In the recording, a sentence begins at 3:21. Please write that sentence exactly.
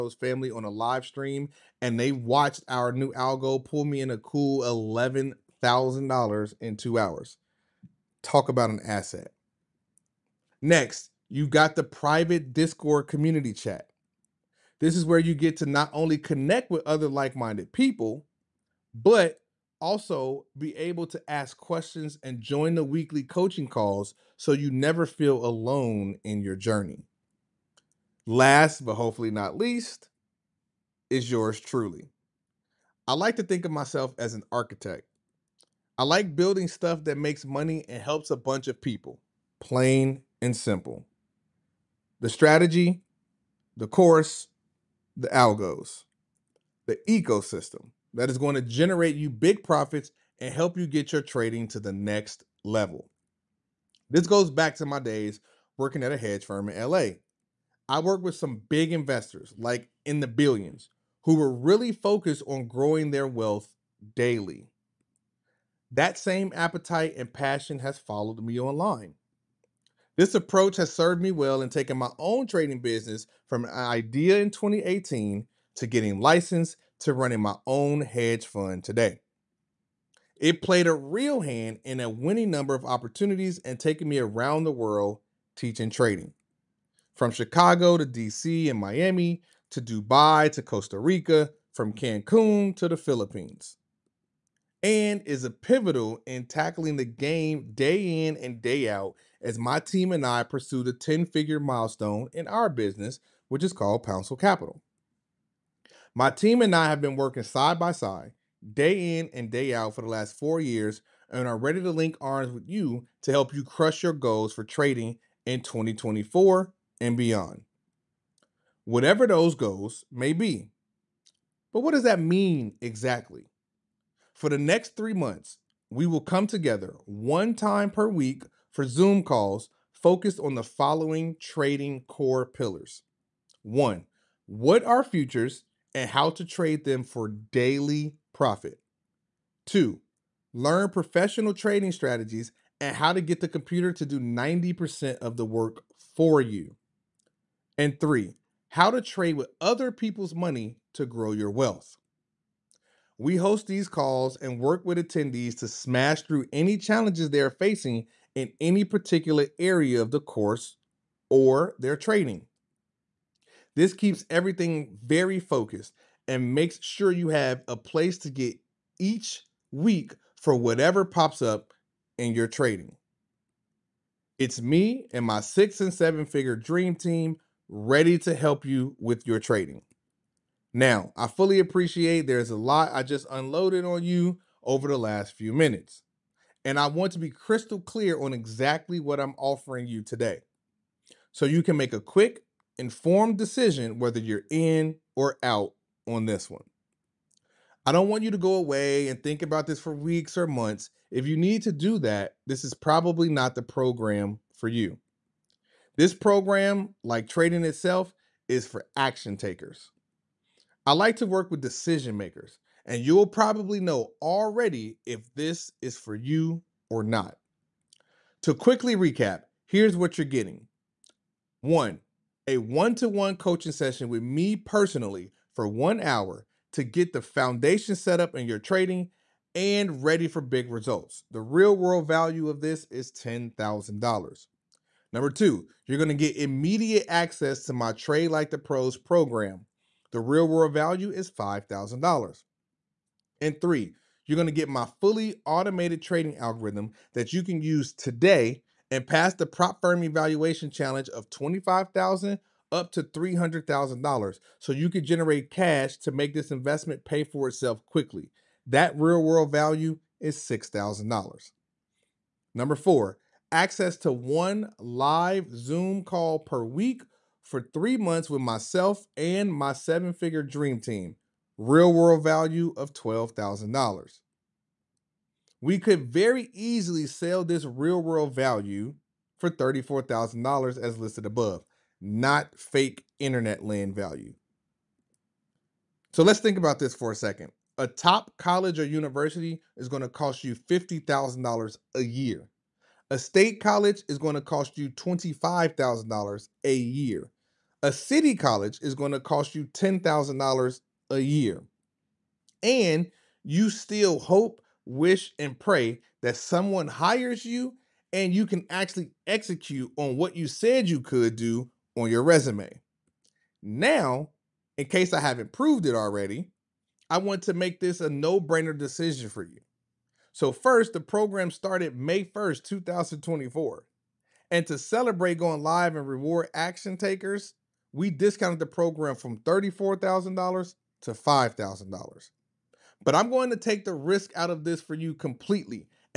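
If you need to do that, this is probably not the program for you.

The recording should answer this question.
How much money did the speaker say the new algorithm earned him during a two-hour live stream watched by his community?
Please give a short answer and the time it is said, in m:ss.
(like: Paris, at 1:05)
$11,000, at 0:04.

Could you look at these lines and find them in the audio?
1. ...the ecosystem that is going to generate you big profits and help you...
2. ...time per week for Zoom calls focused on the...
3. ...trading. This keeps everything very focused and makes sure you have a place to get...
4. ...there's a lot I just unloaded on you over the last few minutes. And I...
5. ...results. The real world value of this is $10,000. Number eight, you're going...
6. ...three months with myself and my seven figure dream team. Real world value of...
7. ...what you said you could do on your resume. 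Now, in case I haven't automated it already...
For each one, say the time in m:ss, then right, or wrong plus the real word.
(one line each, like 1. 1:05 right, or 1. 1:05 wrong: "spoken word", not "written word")
1. 0:46 right
2. 2:07 right
3. 2:41 right
4. 3:02 right
5. 3:50 wrong: "two", not "eight"
6. 4:27 right
7. 5:10 wrong: "proved", not "automated".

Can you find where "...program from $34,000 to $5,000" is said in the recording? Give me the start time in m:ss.
5:28.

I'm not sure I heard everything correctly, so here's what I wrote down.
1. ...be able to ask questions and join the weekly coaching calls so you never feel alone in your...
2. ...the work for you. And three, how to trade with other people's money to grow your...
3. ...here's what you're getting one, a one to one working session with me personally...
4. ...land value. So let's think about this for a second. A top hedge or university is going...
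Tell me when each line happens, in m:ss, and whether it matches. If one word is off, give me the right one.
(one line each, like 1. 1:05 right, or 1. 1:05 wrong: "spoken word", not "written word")
1. 0:20 right
2. 2:25 right
3. 3:39 wrong: "coaching", not "working"
4. 4:43 wrong: "college", not "hedge".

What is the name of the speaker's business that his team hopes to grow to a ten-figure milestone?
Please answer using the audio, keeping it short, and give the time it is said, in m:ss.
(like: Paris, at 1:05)
Pouncil Capital, at 1:44.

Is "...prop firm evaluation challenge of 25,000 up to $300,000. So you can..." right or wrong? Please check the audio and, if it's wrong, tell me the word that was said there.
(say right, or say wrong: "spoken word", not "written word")
right.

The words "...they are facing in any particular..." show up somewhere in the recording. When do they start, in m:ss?
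2:37.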